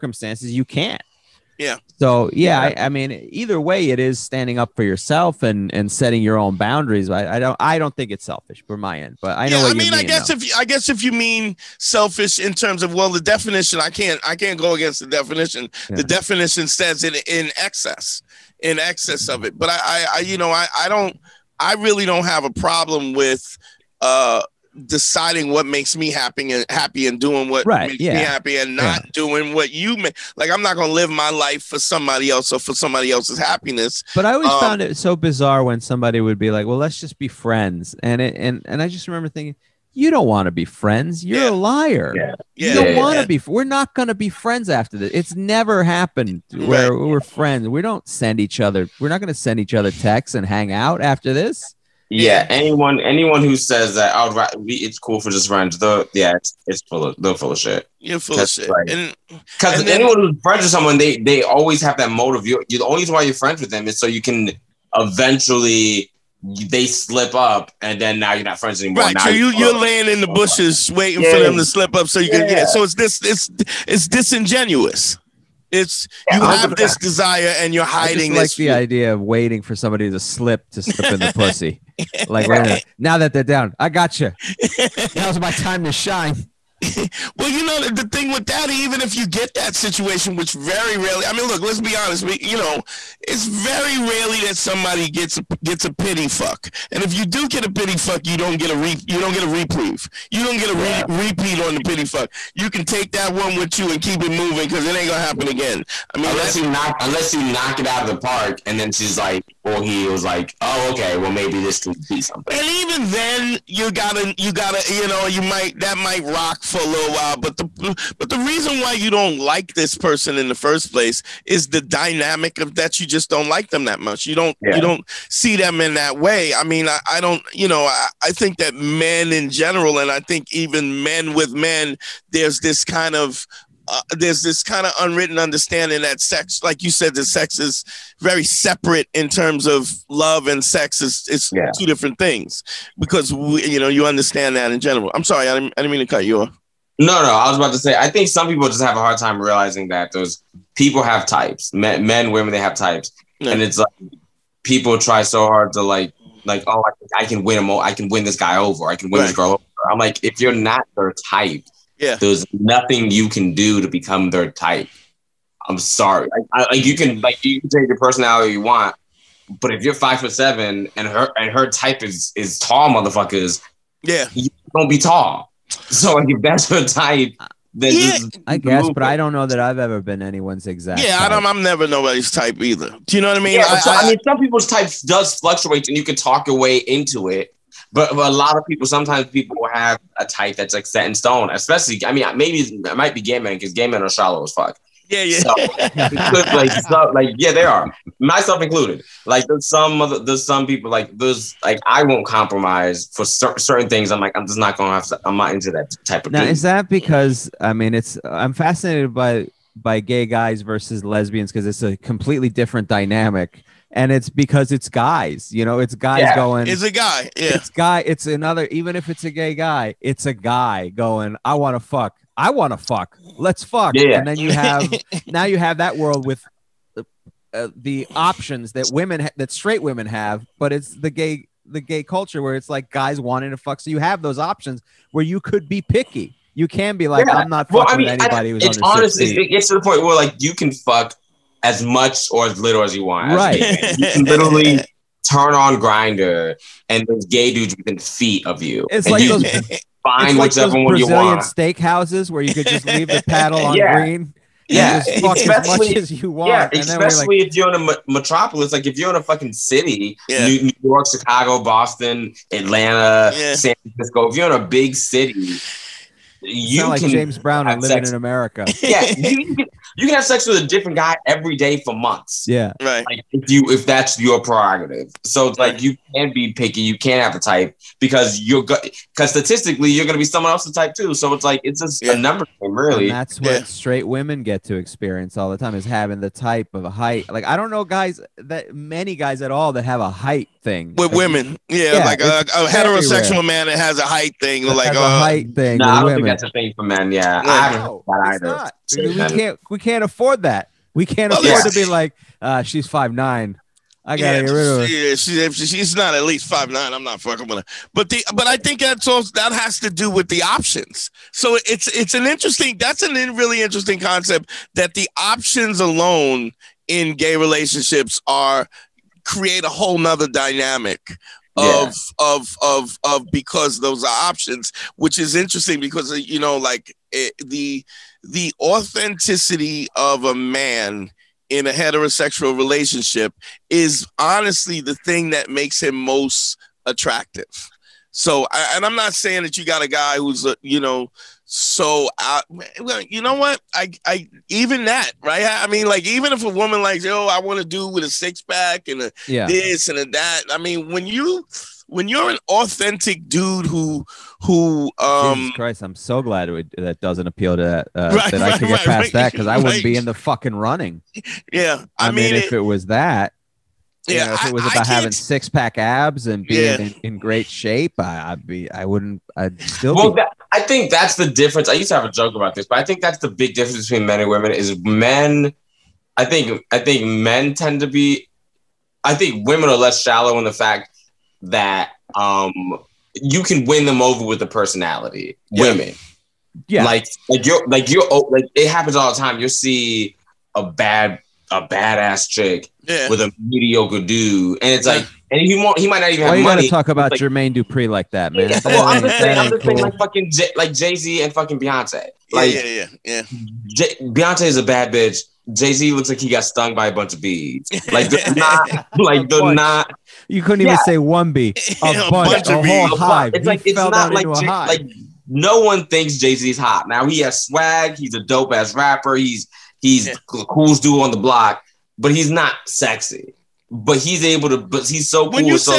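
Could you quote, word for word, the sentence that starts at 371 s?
I used to have a joke about this, but I think that's the big difference between men and women is men.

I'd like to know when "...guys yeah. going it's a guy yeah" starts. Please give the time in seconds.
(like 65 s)
215 s.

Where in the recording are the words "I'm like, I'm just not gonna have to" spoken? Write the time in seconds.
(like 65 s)
204 s.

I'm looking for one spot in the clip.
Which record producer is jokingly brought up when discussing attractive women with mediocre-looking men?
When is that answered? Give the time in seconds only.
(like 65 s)
397 s.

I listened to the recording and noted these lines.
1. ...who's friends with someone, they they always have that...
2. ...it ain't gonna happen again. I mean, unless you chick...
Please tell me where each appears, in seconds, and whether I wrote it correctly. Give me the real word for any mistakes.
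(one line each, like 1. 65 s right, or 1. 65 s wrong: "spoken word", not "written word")
1. 60 s right
2. 104 s wrong: "knock", not "chick".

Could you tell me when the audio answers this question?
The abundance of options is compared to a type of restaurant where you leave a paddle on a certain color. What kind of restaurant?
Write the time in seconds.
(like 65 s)
251 s.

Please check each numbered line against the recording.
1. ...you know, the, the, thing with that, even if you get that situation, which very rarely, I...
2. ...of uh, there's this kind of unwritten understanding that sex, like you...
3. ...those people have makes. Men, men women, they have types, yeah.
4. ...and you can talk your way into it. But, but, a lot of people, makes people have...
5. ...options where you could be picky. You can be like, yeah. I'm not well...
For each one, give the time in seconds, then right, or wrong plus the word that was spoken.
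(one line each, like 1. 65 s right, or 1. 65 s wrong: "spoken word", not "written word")
1. 87 s right
2. 133 s right
3. 150 s wrong: "types", not "makes"
4. 185 s wrong: "sometimes", not "makes"
5. 234 s right.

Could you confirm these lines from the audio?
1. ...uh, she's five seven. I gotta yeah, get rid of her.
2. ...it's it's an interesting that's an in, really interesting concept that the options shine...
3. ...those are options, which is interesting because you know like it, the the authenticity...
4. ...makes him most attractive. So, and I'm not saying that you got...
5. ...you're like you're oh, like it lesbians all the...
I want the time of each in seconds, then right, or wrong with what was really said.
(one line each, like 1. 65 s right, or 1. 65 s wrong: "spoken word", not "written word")
1. 302 s wrong: "nine", not "seven"
2. 311 s wrong: "alone", not "shine"
3. 323 s right
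4. 335 s right
5. 387 s wrong: "happens", not "lesbians".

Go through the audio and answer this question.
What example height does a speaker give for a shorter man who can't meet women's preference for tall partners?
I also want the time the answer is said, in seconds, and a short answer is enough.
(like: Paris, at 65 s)
5'7", at 169 s.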